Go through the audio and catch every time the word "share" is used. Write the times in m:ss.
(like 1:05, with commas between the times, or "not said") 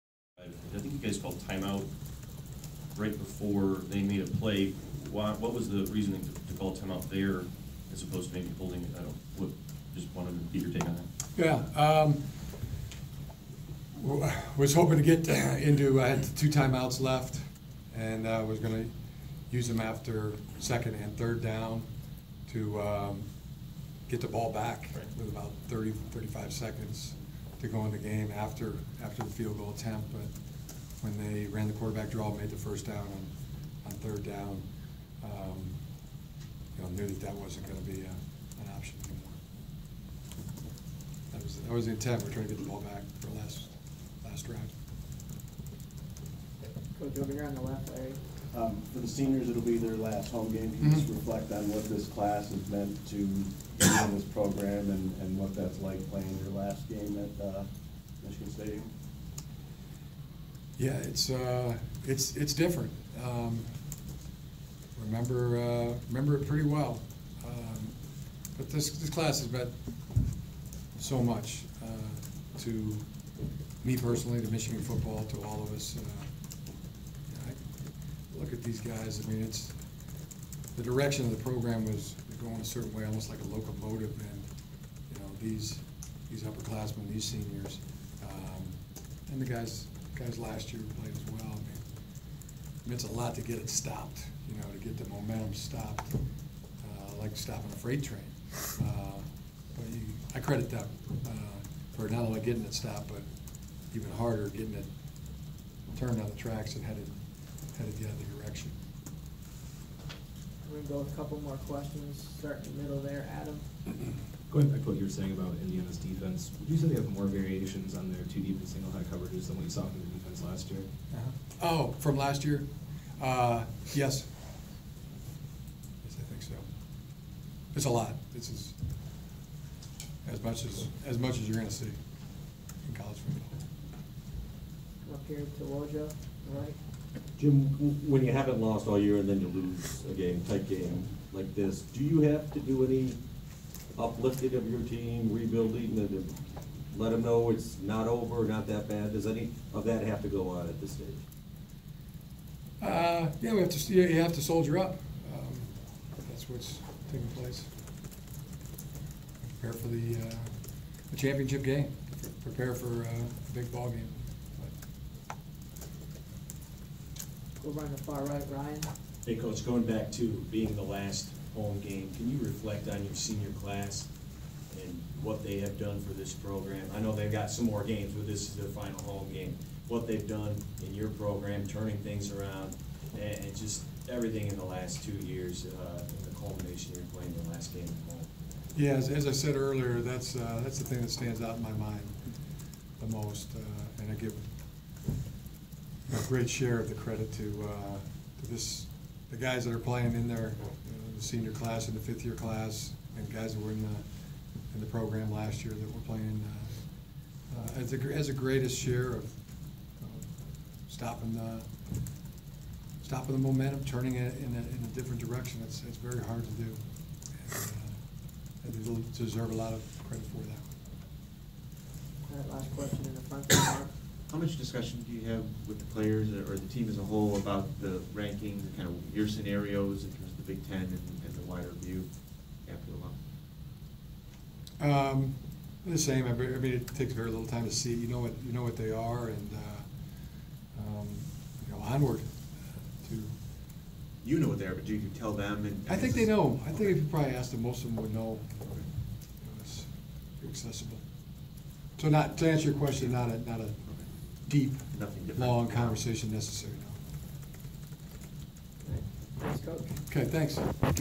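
3:16, 3:28.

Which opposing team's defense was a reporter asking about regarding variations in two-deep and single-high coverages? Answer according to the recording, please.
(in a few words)
Indiana.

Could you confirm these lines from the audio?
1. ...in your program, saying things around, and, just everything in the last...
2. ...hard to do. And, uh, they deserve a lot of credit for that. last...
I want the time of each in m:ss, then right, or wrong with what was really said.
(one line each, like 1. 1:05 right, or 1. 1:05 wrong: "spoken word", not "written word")
1. 3:00 wrong: "turning", not "saying"
2. 3:36 right.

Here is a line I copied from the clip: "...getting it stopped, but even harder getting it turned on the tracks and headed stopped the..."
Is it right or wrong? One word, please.
wrong.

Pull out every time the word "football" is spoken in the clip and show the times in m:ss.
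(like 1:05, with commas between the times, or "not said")
1:14, 2:13.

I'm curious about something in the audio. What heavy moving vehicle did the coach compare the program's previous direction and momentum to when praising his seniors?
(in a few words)
locomotive.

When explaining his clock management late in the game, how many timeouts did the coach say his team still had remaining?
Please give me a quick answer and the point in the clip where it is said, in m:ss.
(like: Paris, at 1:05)
2, at 0:16.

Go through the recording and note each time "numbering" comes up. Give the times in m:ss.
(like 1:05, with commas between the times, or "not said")
not said.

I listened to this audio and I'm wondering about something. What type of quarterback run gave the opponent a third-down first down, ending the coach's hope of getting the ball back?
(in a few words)
quarterback draw.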